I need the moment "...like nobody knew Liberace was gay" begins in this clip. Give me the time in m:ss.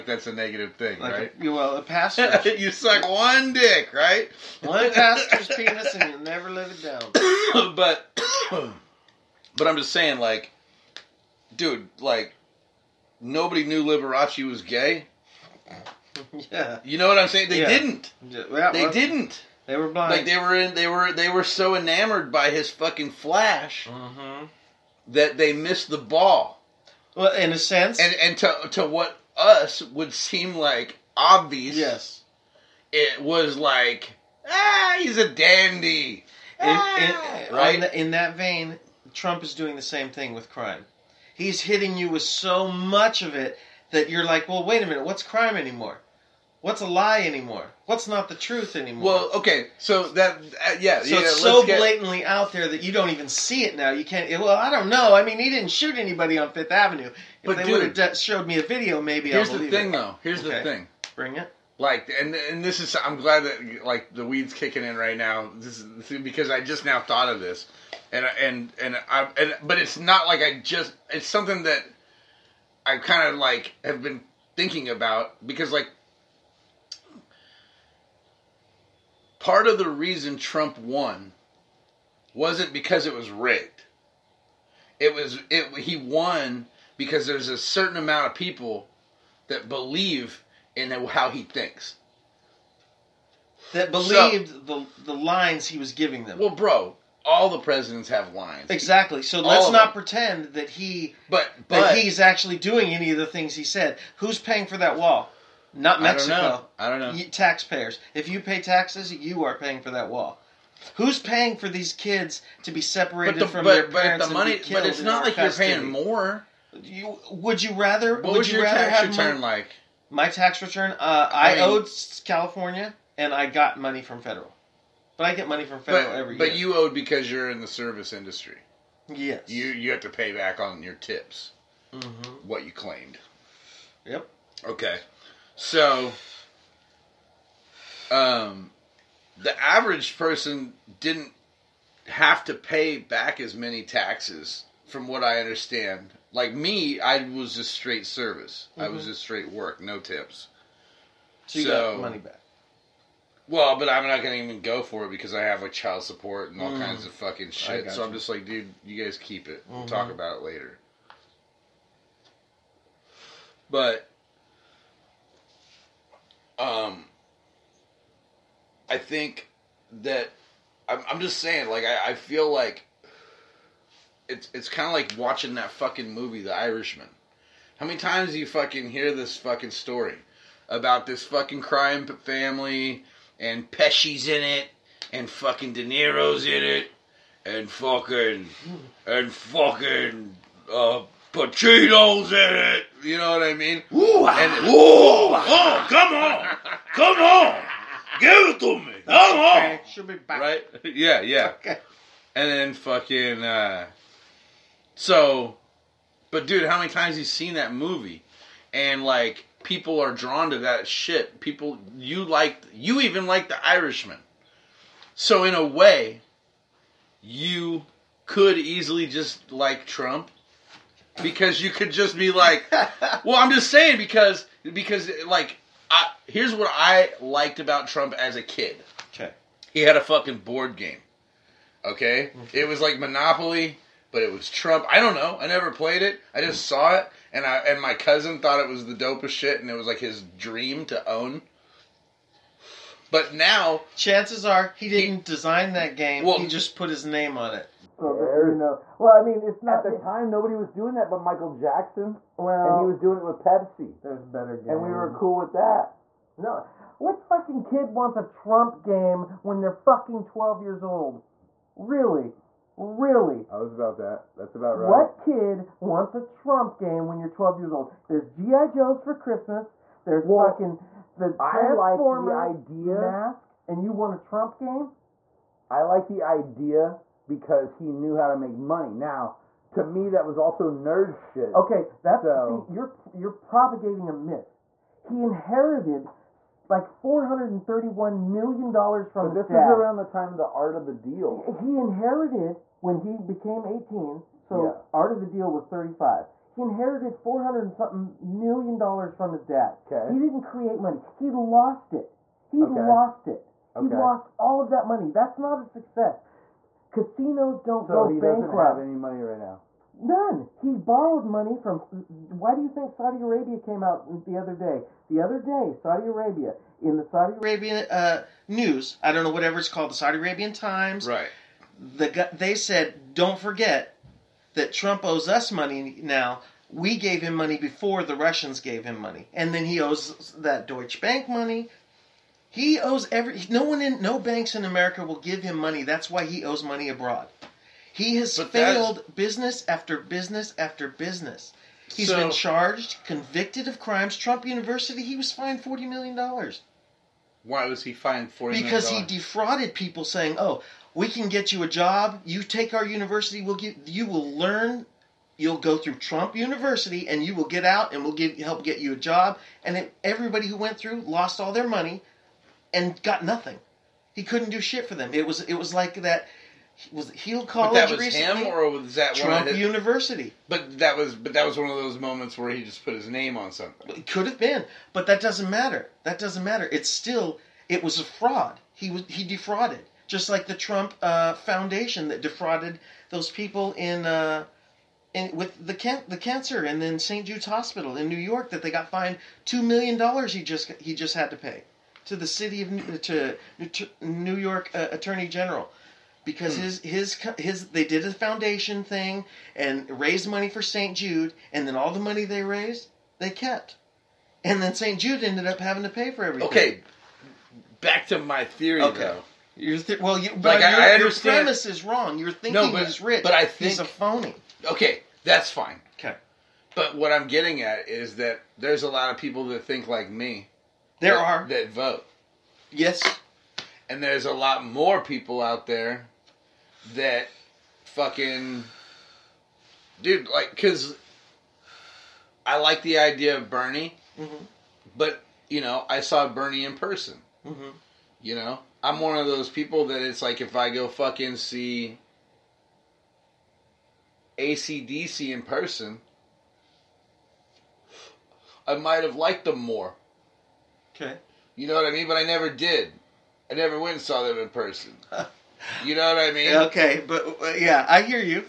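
0:11.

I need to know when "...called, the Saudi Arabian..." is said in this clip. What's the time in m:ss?
5:19.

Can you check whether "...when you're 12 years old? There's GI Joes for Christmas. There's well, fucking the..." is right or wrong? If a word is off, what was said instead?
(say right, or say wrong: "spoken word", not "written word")
right.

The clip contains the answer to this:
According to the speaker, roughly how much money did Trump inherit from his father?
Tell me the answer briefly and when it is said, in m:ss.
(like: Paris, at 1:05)
$431 million, at 4:46.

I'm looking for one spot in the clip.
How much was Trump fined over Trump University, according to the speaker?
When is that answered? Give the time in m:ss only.
5:45.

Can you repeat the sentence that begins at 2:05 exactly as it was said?
But I get money from federal but, every year.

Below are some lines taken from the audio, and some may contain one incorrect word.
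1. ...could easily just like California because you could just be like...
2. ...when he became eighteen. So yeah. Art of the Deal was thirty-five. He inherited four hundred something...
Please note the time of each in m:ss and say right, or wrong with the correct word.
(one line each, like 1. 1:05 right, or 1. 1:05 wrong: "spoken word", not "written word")
1. 3:38 wrong: "Trump", not "California"
2. 4:52 right.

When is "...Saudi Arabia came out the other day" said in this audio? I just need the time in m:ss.
5:12.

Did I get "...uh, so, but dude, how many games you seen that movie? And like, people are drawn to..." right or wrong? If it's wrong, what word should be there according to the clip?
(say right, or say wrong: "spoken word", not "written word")
wrong: "times", not "games".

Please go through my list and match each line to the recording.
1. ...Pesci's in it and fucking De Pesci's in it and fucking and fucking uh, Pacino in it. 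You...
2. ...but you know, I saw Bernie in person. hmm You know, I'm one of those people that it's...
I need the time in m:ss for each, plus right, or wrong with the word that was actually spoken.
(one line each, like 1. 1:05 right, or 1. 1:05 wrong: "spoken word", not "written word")
1. 3:03 wrong: "Niro", not "Pesci"
2. 7:14 right.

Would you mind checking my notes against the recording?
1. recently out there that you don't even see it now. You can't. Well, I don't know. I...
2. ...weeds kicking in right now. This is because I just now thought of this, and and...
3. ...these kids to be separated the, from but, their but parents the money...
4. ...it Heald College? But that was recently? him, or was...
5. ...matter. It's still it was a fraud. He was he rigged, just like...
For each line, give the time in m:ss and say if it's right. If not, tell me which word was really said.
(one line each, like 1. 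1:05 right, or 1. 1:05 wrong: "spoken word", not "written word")
1. 0:51 wrong: "blatantly", not "recently"
2. 1:04 right
3. 1:51 right
4. 6:07 right
5. 6:16 wrong: "defrauded", not "rigged".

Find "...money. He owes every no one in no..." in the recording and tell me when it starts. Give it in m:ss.
5:31.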